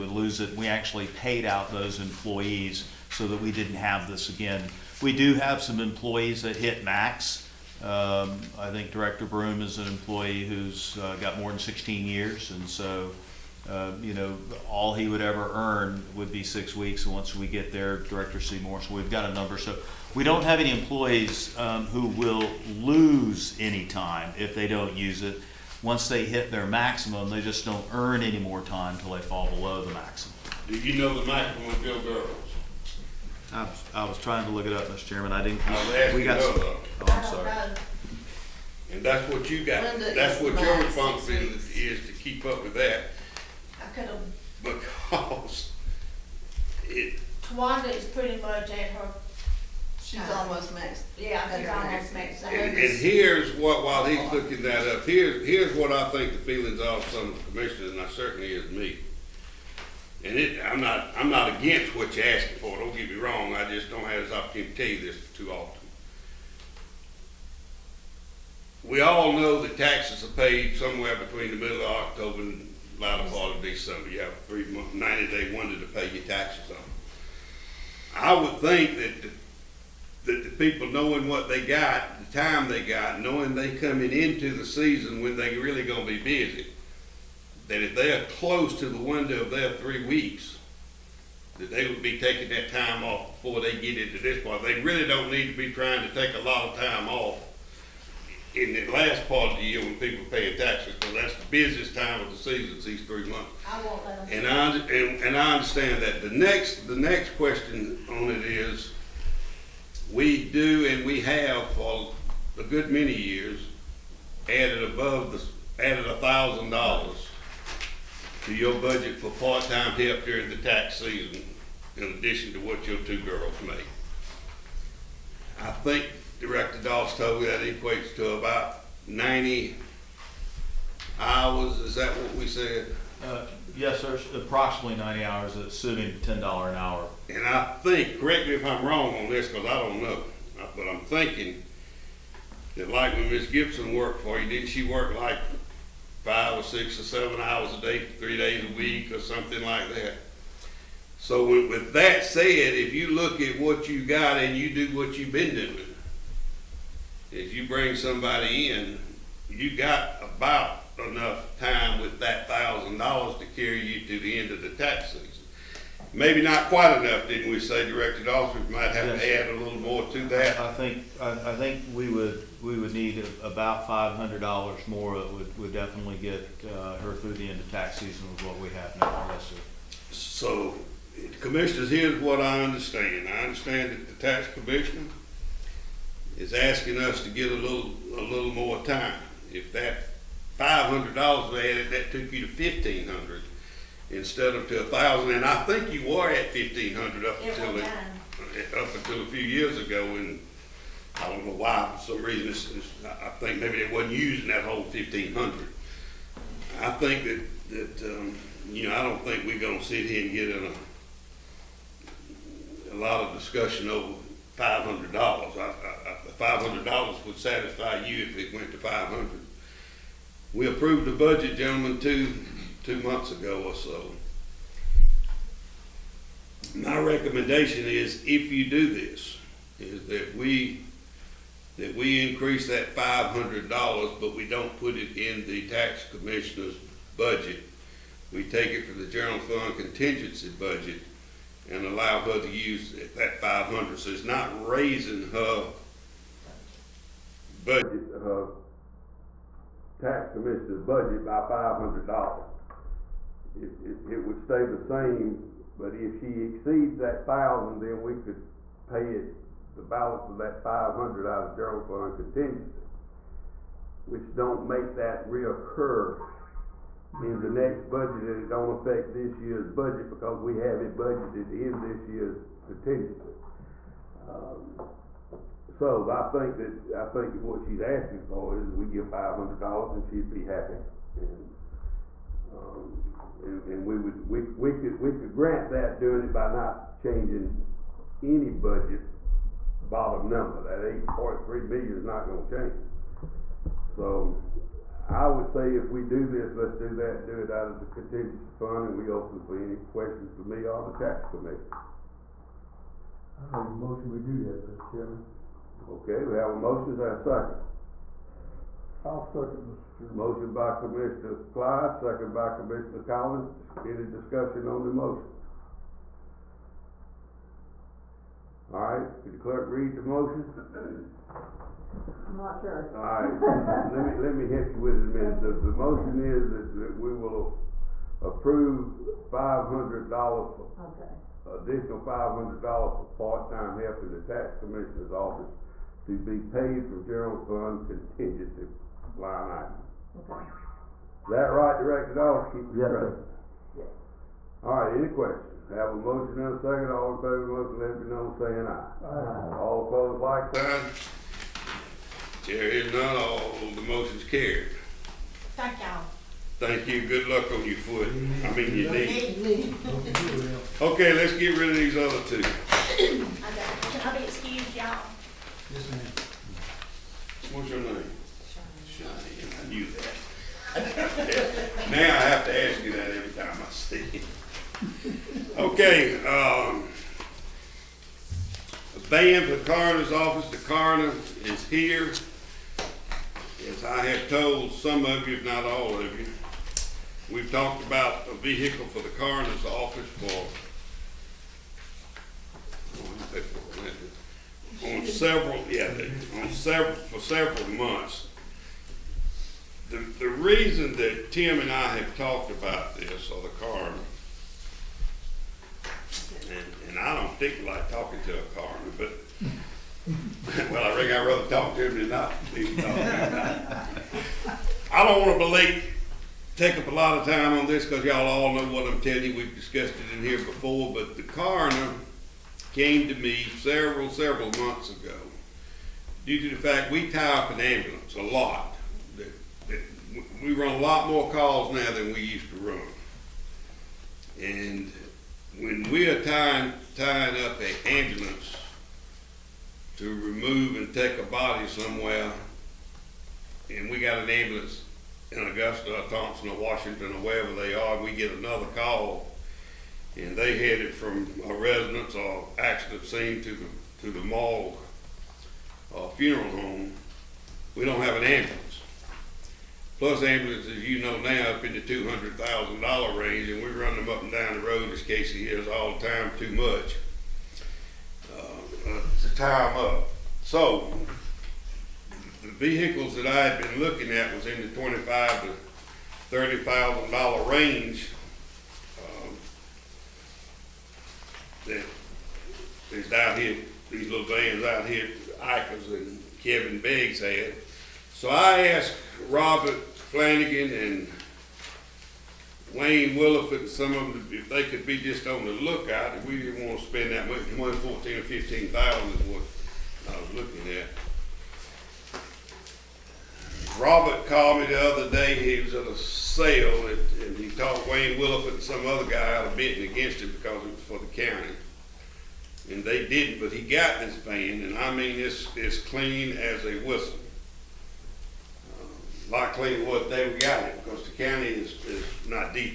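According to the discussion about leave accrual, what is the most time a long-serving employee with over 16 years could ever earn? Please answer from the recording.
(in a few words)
6 weeks.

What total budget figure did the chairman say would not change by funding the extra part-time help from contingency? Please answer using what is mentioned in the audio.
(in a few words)
8.3 million.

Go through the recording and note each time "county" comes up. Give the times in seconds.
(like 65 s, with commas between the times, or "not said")
511 s, 521 s.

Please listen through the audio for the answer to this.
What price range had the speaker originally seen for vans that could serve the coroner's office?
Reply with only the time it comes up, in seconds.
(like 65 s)
474 s.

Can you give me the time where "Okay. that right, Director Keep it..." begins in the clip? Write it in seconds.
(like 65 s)
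340 s.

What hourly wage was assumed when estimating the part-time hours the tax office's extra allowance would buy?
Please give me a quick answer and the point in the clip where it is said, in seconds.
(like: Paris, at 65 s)
$10 an hour, at 136 s.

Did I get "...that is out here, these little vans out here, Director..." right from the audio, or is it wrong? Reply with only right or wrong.
wrong.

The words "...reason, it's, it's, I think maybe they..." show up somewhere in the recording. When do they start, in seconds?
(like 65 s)
202 s.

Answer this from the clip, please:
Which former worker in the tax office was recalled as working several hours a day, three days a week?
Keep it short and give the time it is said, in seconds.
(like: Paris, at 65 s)
Miss Gibson, at 143 s.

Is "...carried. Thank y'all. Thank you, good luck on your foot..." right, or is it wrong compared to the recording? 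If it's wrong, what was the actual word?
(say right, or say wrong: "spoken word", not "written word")
right.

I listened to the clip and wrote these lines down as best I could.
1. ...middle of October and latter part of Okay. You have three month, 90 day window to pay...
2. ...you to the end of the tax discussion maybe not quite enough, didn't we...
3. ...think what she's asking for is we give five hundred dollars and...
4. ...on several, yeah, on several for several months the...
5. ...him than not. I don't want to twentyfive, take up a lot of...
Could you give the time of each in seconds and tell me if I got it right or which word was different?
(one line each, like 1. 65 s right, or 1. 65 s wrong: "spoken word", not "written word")
1. 71 s wrong: "December", not "Okay"
2. 163 s wrong: "season", not "discussion"
3. 277 s right
4. 394 s right
5. 411 s wrong: "believe", not "twentyfive".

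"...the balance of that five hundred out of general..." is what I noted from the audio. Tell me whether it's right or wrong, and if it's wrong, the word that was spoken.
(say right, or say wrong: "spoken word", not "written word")
right.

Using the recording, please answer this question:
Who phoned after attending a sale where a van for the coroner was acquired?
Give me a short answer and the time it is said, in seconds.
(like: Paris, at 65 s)
Robert Flanagan, at 489 s.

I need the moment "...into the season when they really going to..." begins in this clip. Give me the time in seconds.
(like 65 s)
84 s.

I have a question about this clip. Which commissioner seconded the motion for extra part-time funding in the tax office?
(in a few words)
Commissioner Collins.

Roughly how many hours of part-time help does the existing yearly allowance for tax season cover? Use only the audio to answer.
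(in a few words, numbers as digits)
90 hours.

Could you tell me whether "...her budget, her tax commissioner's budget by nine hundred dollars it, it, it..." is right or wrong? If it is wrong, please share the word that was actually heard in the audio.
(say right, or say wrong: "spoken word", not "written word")
wrong: "five", not "nine".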